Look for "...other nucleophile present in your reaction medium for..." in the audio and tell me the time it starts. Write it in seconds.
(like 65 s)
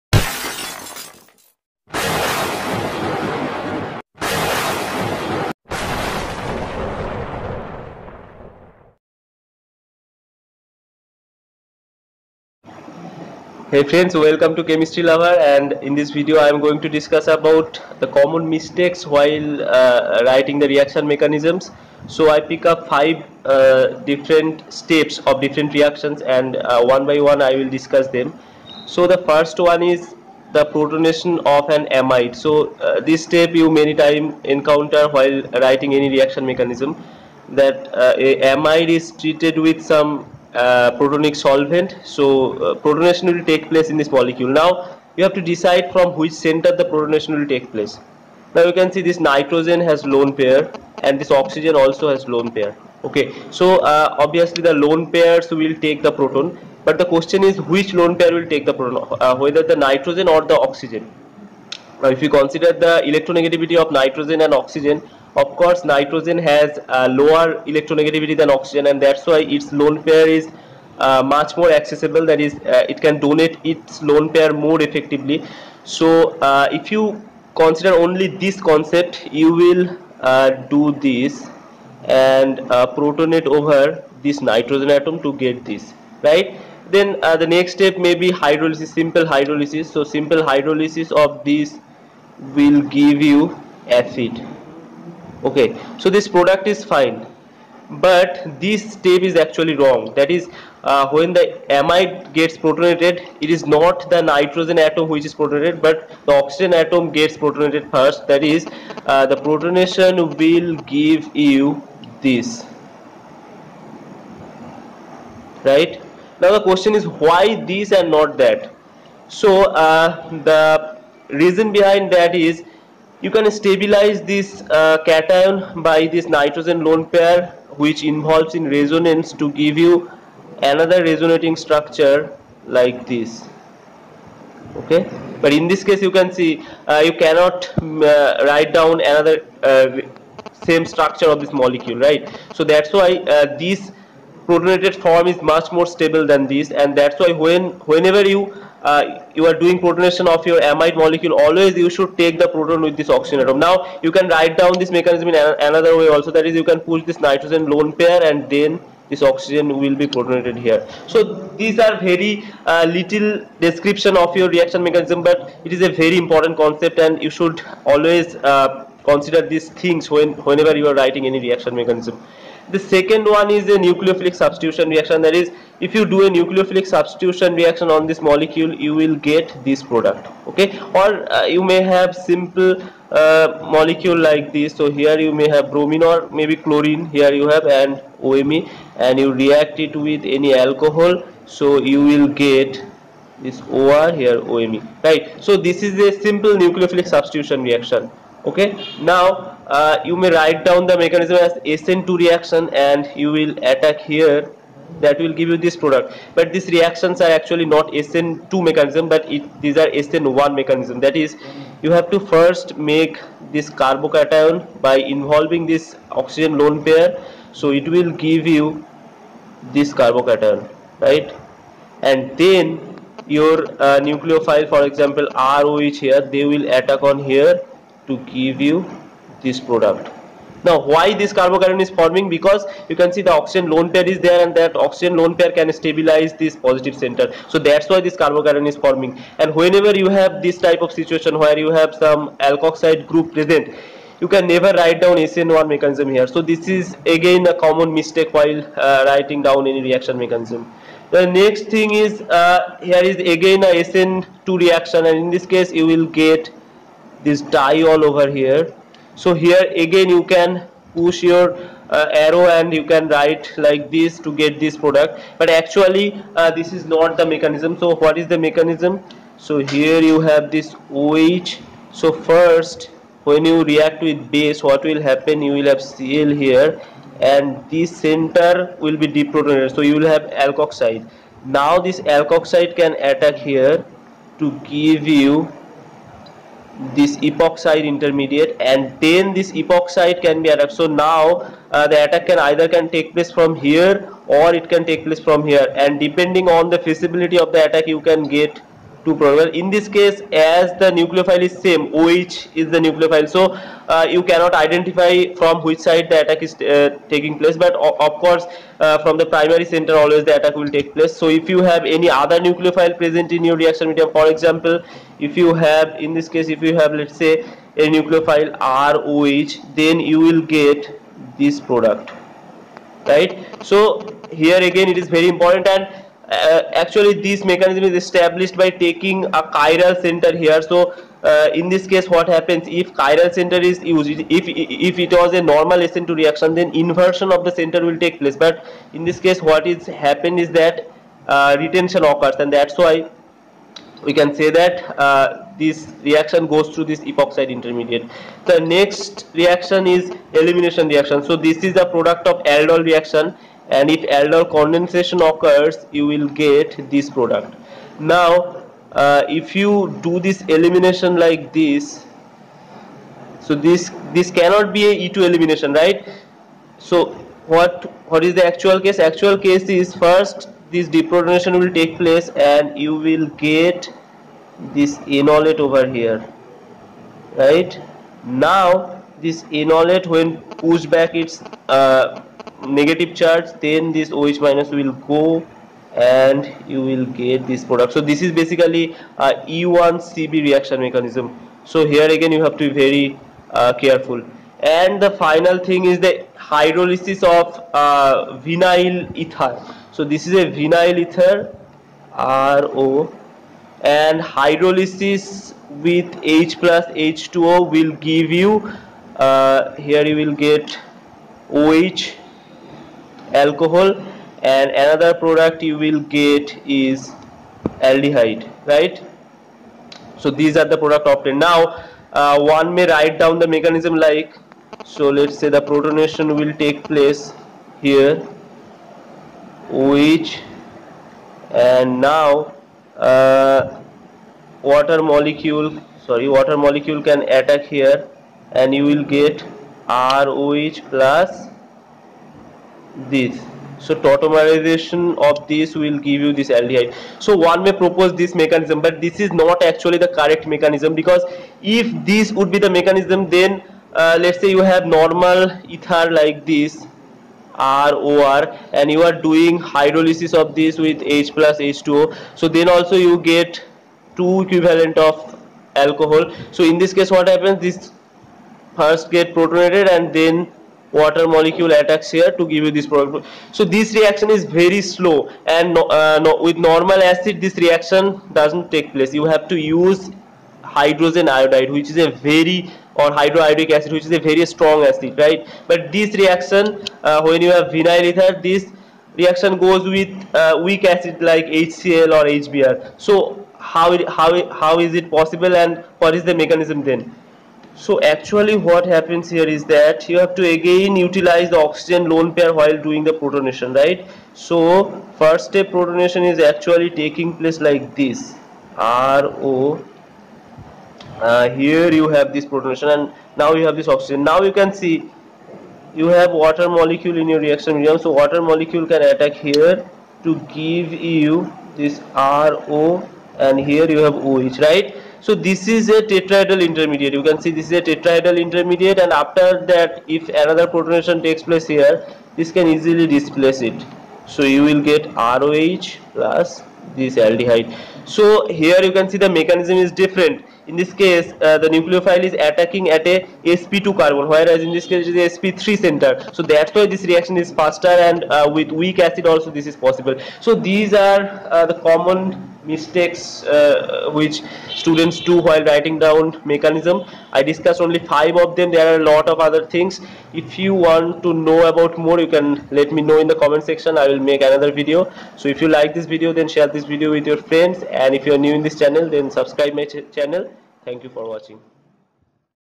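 312 s.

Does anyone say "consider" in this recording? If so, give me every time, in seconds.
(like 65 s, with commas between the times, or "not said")
62 s, 77 s, 169 s.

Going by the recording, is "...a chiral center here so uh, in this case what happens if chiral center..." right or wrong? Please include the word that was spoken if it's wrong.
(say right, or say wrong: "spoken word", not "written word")
right.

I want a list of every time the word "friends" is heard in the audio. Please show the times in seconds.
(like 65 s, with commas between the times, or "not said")
13 s, 567 s.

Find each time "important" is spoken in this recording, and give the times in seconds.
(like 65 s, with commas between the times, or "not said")
166 s, 325 s.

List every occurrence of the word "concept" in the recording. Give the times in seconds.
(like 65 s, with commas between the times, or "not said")
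78 s, 166 s.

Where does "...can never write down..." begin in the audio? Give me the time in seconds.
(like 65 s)
244 s.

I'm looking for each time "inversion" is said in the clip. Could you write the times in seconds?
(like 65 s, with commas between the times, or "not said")
336 s.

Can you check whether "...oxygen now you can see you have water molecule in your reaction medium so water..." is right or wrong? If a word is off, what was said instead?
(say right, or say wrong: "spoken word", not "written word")
right.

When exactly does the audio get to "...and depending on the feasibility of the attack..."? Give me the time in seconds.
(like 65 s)
295 s.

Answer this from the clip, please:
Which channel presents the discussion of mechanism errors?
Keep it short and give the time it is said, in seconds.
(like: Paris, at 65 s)
Chemistry Lover, at 14 s.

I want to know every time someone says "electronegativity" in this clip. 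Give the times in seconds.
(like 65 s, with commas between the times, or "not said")
63 s, 67 s.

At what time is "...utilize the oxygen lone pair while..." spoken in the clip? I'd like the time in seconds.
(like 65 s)
500 s.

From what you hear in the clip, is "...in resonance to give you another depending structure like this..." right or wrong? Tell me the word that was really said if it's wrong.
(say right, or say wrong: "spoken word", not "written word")
wrong: "resonating", not "depending".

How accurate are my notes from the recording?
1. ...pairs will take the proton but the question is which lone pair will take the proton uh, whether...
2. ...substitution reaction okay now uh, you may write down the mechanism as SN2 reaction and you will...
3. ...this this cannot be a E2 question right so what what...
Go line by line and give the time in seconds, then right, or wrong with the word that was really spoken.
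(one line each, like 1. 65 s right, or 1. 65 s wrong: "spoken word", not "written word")
1. 55 s right
2. 197 s right
3. 363 s wrong: "elimination", not "question".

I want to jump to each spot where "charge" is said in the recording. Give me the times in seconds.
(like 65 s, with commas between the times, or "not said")
383 s.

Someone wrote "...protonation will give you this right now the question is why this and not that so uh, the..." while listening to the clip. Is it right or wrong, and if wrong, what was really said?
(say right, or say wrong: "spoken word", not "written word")
right.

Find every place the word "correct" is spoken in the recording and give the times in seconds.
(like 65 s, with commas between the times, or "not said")
450 s.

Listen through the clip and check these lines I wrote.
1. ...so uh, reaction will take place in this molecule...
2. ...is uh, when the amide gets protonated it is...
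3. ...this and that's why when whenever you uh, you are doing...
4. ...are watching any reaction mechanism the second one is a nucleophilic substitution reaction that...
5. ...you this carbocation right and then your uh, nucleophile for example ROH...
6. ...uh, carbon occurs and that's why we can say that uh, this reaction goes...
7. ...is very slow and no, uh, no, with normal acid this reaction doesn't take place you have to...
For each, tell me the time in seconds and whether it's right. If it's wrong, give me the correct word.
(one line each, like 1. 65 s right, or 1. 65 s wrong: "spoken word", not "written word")
1. 42 s wrong: "protonation", not "reaction"
2. 100 s right
3. 146 s right
4. 170 s wrong: "writing", not "watching"
5. 218 s right
6. 341 s wrong: "retention", not "carbon"
7. 474 s right.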